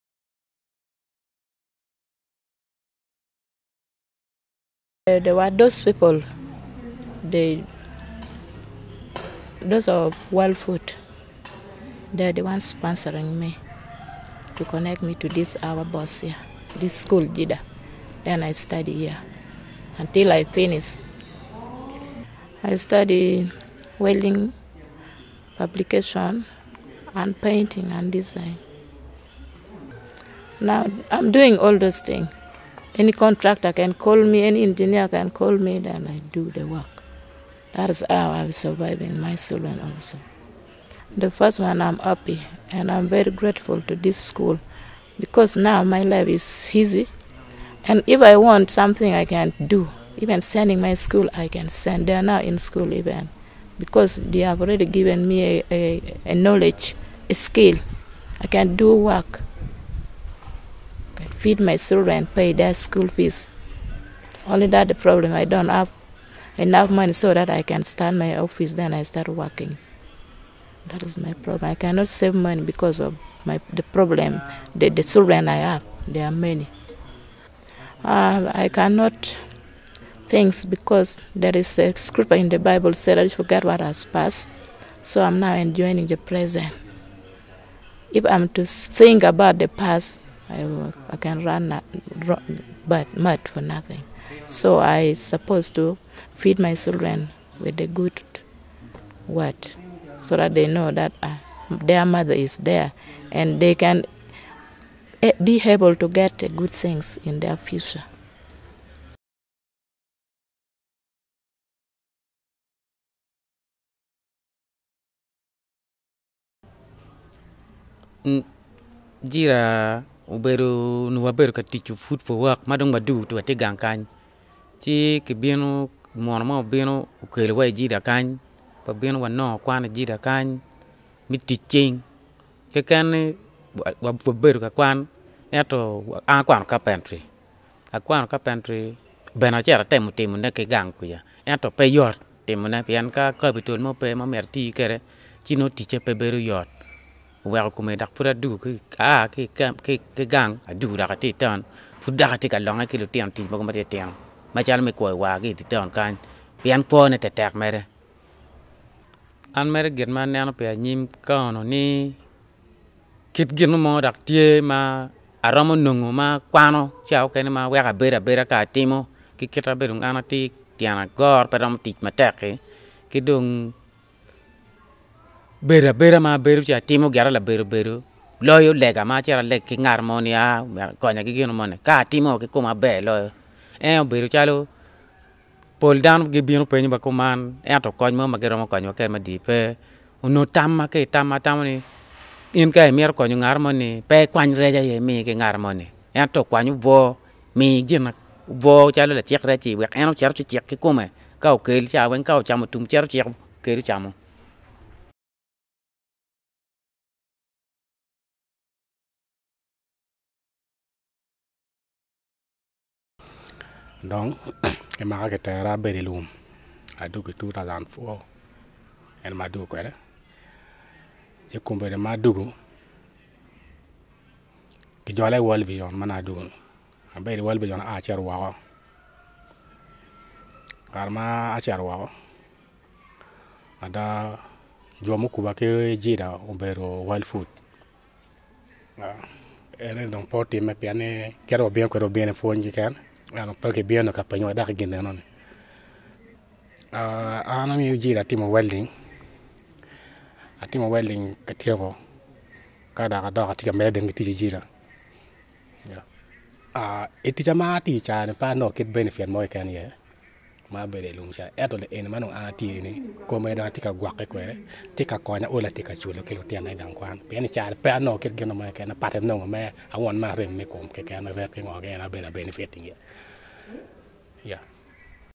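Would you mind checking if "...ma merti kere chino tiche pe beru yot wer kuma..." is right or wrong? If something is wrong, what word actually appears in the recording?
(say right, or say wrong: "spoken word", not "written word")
right.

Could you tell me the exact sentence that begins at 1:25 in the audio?
So I'm now enjoying the present.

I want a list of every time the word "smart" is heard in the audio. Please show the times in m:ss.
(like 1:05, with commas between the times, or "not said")
not said.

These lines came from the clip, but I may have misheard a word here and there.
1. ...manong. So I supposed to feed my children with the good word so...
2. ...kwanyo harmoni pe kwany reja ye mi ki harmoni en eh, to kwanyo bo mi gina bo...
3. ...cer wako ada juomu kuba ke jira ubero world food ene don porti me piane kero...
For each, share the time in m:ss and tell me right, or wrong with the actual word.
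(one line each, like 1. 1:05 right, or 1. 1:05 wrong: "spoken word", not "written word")
1. 1:33 wrong: "nothing", not "manong"
2. 3:13 wrong: "konyo", not "kwanyo"
3. 3:51 right.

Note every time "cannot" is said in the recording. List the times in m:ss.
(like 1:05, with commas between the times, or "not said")
1:11, 1:18.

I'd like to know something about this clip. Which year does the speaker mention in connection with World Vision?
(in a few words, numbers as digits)
2004.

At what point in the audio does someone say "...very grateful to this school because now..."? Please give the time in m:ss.
0:43.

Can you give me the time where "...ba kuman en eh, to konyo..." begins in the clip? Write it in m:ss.
3:06.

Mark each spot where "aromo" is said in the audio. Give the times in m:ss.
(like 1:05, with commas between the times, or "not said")
2:45.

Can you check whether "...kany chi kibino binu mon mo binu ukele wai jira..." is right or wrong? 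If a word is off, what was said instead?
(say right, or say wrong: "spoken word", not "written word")
right.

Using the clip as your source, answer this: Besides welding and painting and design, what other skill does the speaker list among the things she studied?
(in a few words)
publication.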